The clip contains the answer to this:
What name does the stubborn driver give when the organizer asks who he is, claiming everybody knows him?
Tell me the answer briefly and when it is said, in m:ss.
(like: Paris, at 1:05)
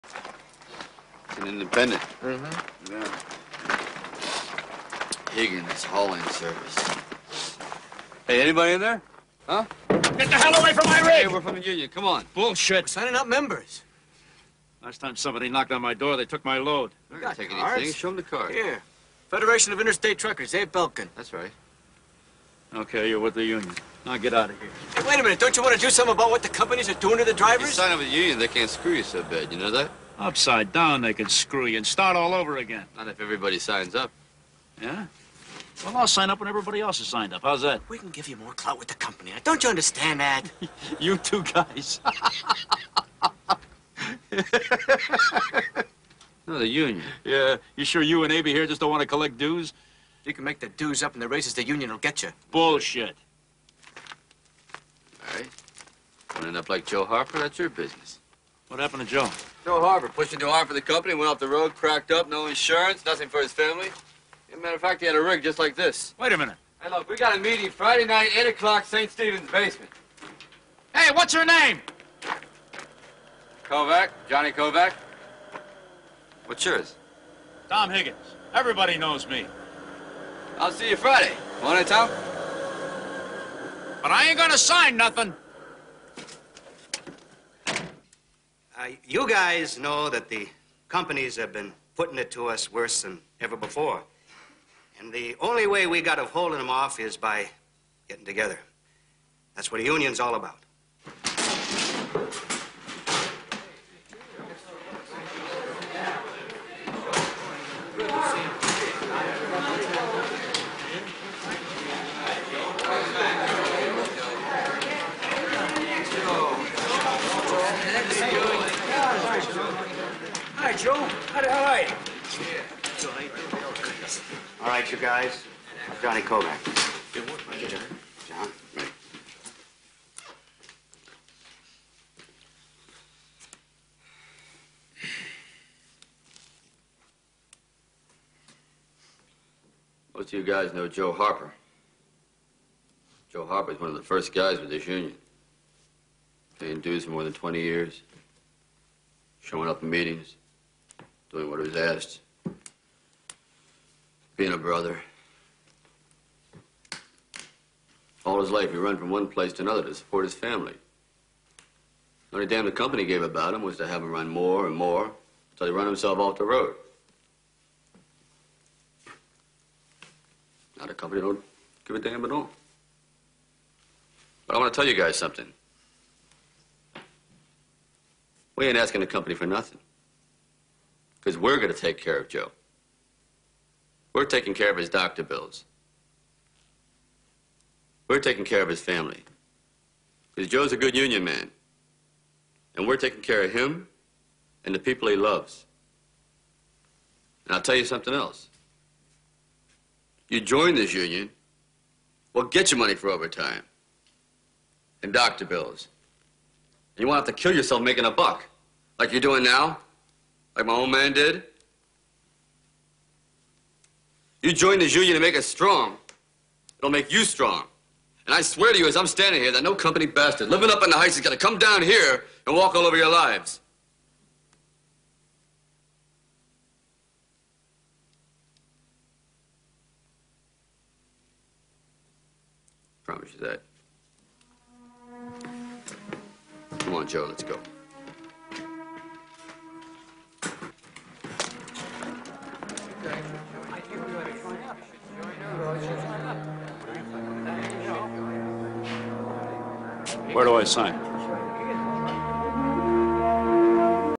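Tom Higgins, at 1:17.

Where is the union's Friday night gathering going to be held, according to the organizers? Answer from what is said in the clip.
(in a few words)
St. Stephen's basement.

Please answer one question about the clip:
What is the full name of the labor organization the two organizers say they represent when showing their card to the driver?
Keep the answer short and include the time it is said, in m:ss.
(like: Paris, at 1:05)
Federation of Interstate Truckers, at 0:19.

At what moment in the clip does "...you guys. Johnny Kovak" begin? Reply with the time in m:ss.
2:04.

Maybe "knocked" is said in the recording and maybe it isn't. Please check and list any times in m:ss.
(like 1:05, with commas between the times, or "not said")
0:15.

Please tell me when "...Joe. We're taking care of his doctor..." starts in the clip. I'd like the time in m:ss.
3:02.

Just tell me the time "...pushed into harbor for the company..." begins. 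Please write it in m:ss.
1:00.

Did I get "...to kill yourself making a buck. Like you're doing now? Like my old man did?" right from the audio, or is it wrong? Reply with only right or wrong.
right.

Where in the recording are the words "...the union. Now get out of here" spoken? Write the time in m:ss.
0:23.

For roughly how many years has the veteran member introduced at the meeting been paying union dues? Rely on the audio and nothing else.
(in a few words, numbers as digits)
more than 20 years.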